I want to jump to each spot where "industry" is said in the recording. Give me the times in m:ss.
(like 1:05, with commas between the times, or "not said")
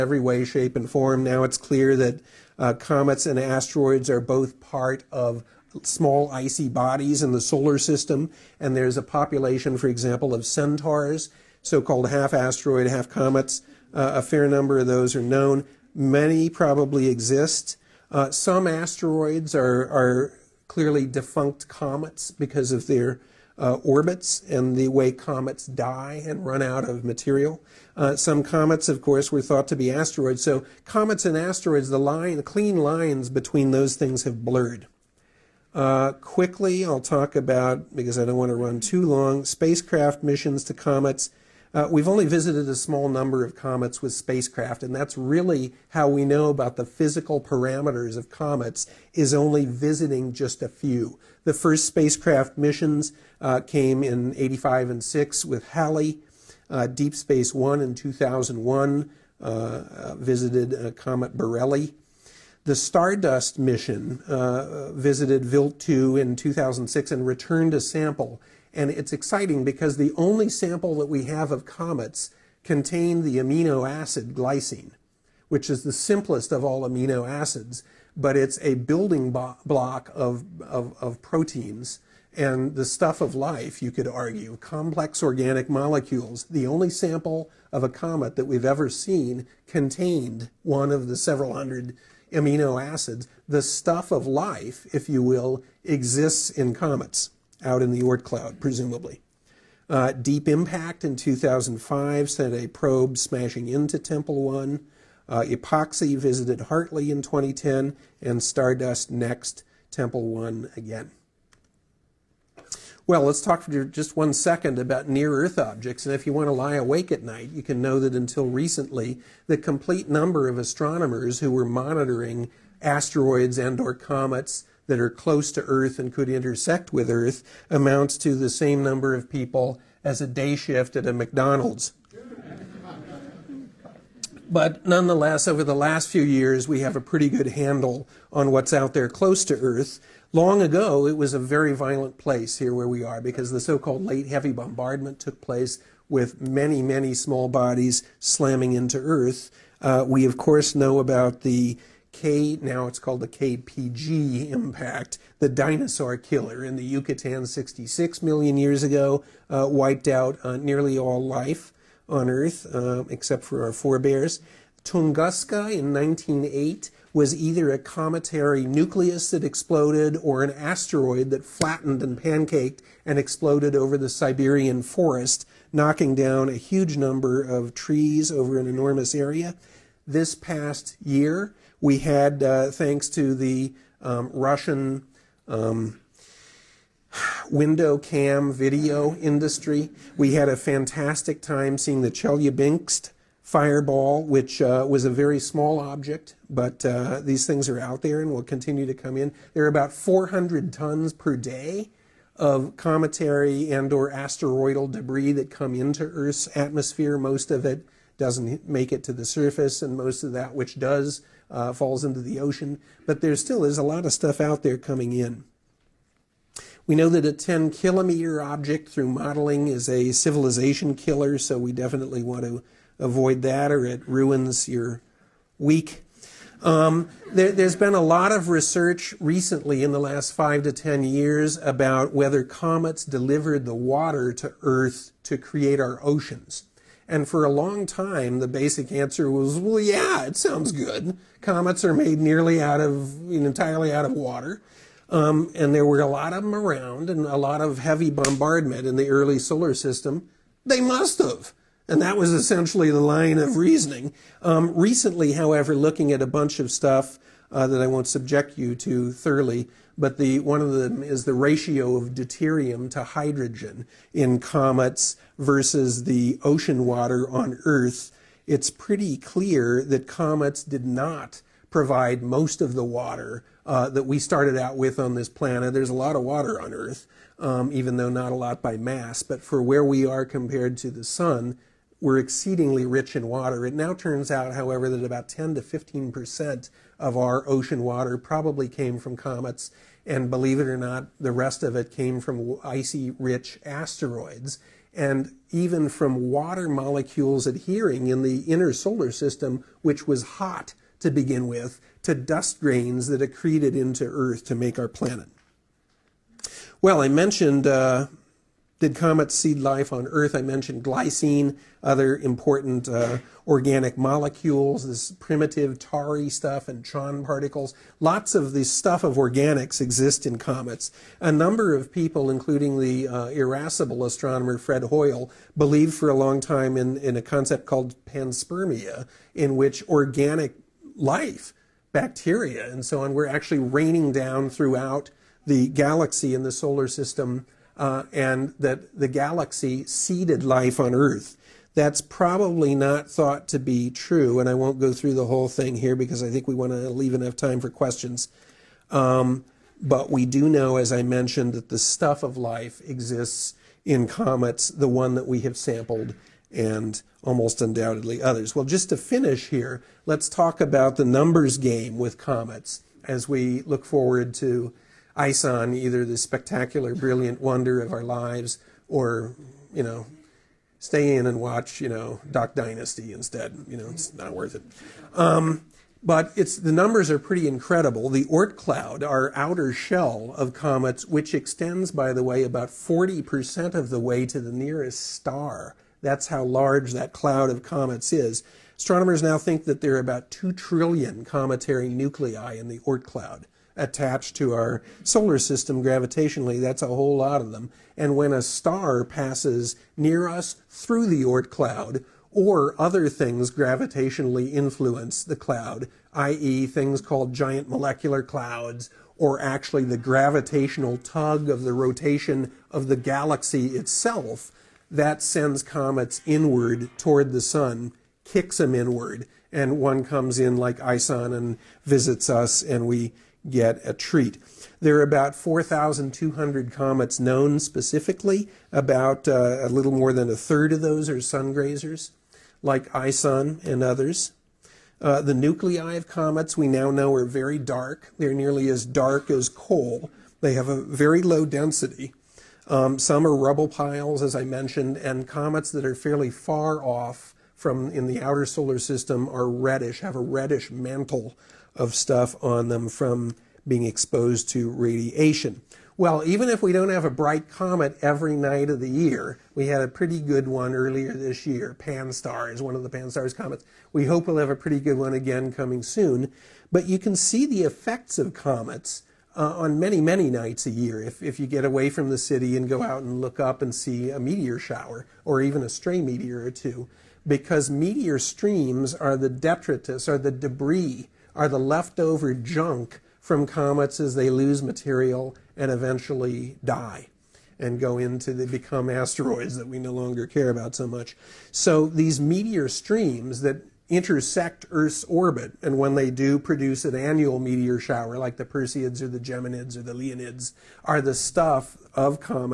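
3:09.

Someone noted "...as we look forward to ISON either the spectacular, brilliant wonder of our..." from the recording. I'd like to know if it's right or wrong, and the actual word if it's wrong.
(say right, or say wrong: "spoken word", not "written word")
right.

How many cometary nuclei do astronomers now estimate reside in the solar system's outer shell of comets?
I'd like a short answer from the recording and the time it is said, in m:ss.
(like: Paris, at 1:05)
2 trillion, at 6:30.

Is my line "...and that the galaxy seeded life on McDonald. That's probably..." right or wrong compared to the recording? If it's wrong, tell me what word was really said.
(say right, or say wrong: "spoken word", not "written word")
wrong: "Earth", not "McDonald".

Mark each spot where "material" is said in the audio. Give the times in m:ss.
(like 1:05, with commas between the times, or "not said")
0:27, 8:04.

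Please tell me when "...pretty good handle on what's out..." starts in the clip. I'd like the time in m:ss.
2:17.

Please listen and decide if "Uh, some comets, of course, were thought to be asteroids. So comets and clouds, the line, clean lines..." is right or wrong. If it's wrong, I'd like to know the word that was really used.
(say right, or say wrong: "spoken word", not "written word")
wrong: "asteroids", not "clouds".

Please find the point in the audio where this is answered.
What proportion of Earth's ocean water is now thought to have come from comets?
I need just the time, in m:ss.
4:45.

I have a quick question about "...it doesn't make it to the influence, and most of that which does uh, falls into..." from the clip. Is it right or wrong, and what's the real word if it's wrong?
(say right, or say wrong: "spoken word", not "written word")
wrong: "surface", not "influence".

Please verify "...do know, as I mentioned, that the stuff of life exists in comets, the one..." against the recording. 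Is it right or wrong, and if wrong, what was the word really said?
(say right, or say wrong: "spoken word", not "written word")
right.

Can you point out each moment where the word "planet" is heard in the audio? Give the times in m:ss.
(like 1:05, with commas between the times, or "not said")
4:35, 5:04.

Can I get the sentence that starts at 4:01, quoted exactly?
Comets are made nearly out of, entirely out of water.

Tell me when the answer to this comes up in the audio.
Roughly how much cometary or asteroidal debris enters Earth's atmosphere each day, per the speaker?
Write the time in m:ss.
3:19.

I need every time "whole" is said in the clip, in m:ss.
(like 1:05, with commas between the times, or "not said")
5:45, 6:36.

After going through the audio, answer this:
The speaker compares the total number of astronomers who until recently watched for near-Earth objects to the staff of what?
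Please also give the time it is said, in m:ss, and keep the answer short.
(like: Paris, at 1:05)
a day shift at a McDonald's, at 2:10.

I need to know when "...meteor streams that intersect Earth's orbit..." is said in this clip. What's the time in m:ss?
8:12.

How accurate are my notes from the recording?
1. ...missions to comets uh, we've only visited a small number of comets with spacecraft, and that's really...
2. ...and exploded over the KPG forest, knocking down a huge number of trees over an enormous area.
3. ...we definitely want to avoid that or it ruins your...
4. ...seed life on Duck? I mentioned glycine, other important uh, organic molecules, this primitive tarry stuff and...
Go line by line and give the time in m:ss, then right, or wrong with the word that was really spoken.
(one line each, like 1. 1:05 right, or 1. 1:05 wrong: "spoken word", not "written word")
1. 0:40 right
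2. 2:53 wrong: "Siberian", not "KPG"
3. 3:41 right
4. 5:09 wrong: "Earth", not "Duck".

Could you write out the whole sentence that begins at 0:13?
Uh, a fair number of those are known.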